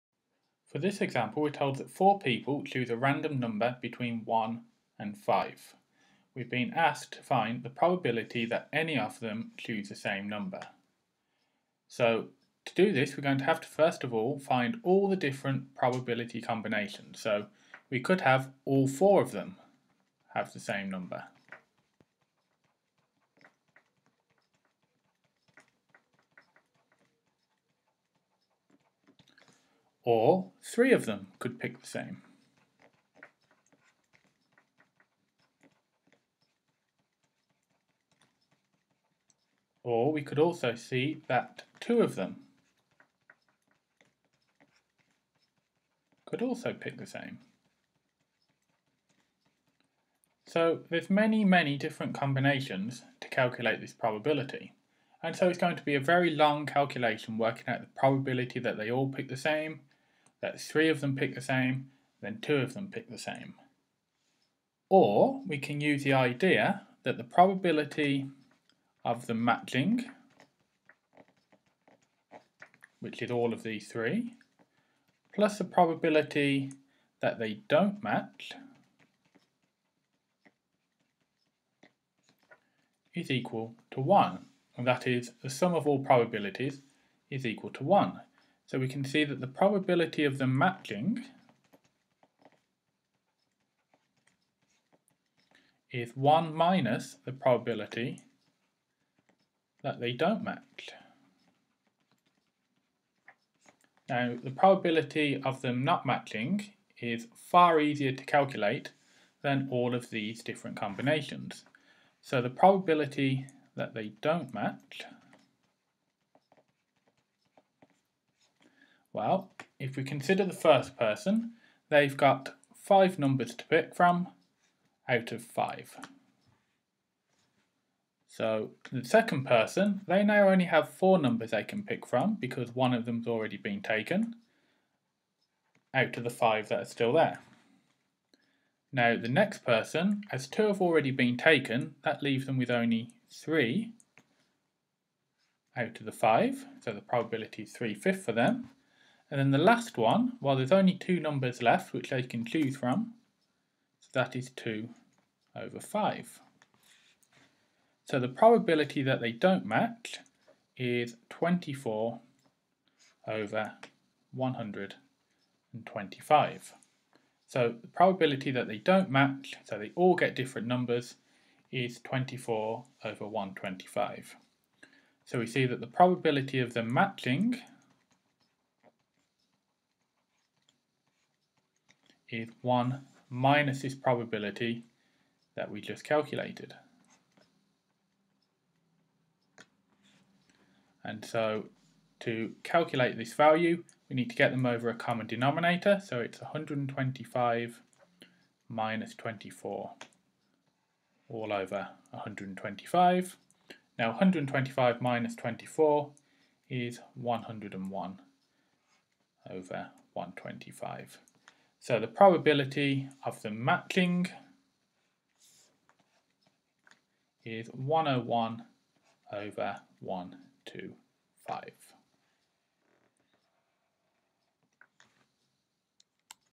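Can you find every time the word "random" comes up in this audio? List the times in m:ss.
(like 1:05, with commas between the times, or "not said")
0:02.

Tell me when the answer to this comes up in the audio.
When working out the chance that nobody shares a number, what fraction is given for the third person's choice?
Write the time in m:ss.
2:27.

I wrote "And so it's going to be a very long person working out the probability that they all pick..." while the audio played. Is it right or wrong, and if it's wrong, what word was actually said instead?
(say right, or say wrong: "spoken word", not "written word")
wrong: "calculation", not "person".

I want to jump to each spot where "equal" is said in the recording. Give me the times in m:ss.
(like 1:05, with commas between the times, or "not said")
1:23, 1:27.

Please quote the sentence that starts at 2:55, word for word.
So we see that the probability of them matching is 1 minus this probability that we just calculated.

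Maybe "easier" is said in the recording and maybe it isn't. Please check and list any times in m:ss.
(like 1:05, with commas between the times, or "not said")
1:47.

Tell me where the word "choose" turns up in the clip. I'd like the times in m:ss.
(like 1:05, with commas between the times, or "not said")
0:02, 0:09, 2:32.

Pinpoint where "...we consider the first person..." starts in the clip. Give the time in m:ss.
1:59.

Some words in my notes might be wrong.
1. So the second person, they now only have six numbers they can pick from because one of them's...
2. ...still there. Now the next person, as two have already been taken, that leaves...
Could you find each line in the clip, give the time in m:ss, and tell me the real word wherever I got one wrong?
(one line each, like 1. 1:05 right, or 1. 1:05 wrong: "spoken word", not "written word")
1. 2:08 wrong: "four", not "six"
2. 2:16 right.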